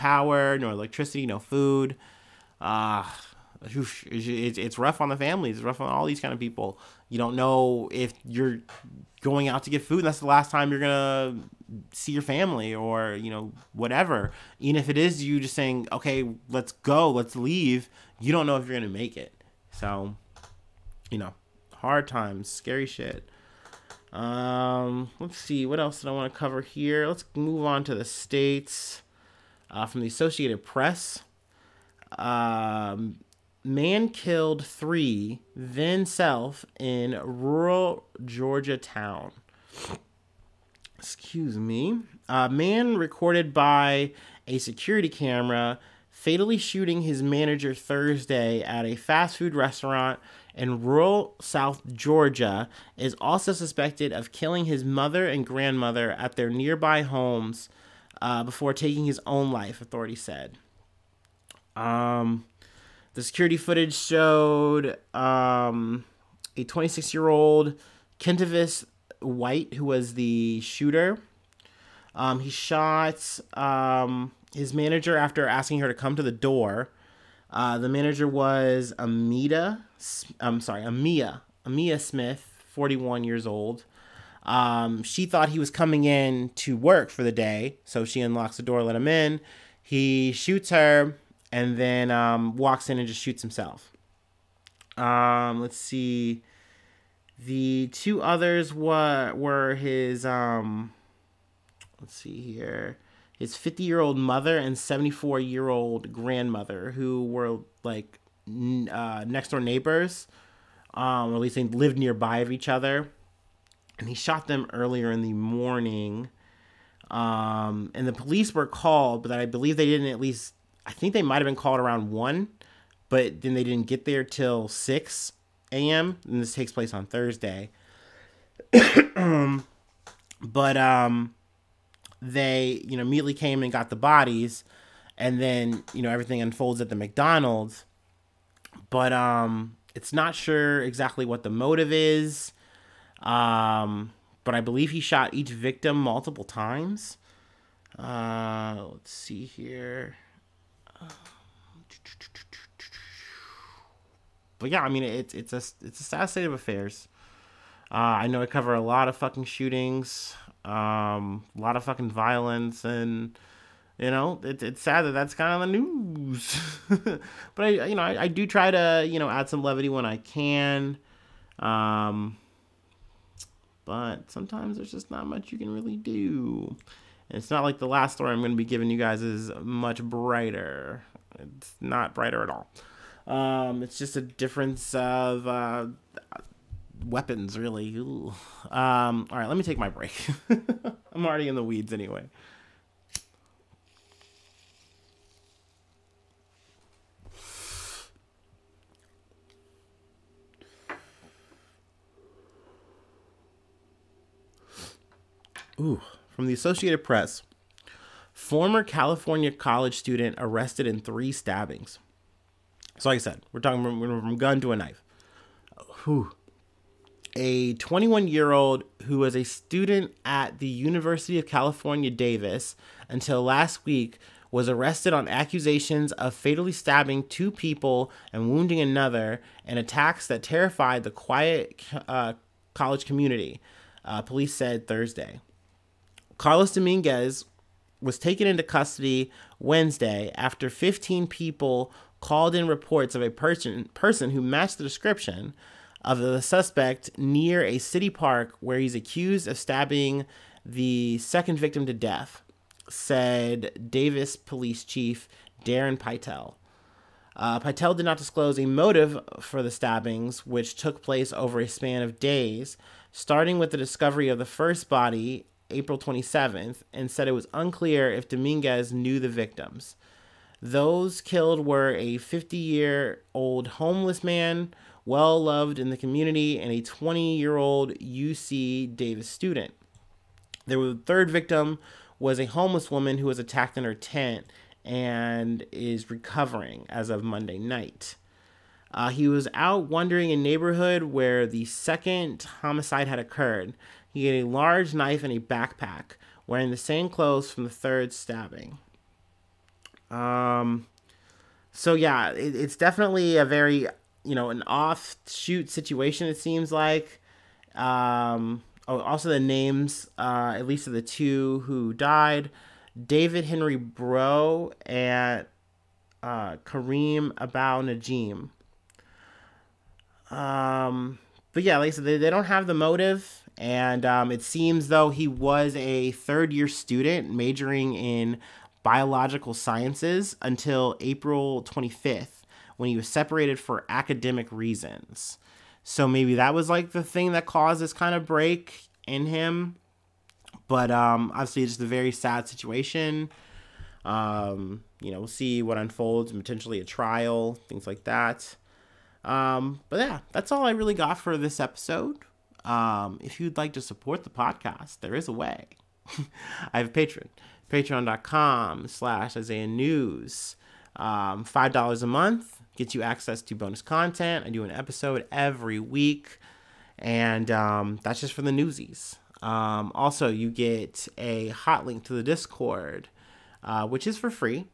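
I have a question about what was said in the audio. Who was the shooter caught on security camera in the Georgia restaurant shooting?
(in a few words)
Kentavis White.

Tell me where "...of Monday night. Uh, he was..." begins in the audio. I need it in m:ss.
4:47.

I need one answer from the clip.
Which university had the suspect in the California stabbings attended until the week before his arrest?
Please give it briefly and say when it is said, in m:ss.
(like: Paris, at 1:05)
University of California, Davis, at 3:40.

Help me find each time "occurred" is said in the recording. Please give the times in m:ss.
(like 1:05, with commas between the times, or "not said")
4:53.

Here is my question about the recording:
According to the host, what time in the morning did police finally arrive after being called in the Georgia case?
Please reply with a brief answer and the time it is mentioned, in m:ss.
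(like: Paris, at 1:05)
6 a.m., at 2:04.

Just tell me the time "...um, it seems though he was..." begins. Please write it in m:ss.
5:24.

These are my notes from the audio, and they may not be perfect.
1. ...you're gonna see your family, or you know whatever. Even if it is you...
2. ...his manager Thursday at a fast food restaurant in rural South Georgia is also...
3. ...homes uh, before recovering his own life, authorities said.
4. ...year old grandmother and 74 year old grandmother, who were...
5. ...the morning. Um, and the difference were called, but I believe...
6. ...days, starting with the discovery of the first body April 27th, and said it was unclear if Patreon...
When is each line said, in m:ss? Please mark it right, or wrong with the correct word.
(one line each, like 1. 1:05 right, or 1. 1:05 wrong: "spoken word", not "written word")
1. 0:10 right
2. 0:47 right
3. 0:57 wrong: "taking", not "recovering"
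4. 1:43 wrong: "mother", not "grandmother"
5. 1:55 wrong: "police", not "difference"
6. 4:22 wrong: "Dominguez", not "Patreon".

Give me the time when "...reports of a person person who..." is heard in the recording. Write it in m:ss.
4:02.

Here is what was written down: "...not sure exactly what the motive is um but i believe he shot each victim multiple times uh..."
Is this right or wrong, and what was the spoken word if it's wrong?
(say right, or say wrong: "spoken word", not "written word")
right.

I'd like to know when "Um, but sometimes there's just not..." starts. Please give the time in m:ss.
2:51.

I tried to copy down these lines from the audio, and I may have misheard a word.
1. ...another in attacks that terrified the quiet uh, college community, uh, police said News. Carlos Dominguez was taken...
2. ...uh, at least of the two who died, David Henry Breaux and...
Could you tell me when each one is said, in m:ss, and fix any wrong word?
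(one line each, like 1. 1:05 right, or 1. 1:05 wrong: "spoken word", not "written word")
1. 3:48 wrong: "Thursday", not "News"
2. 5:10 right.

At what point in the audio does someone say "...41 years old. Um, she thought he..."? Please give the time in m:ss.
1:22.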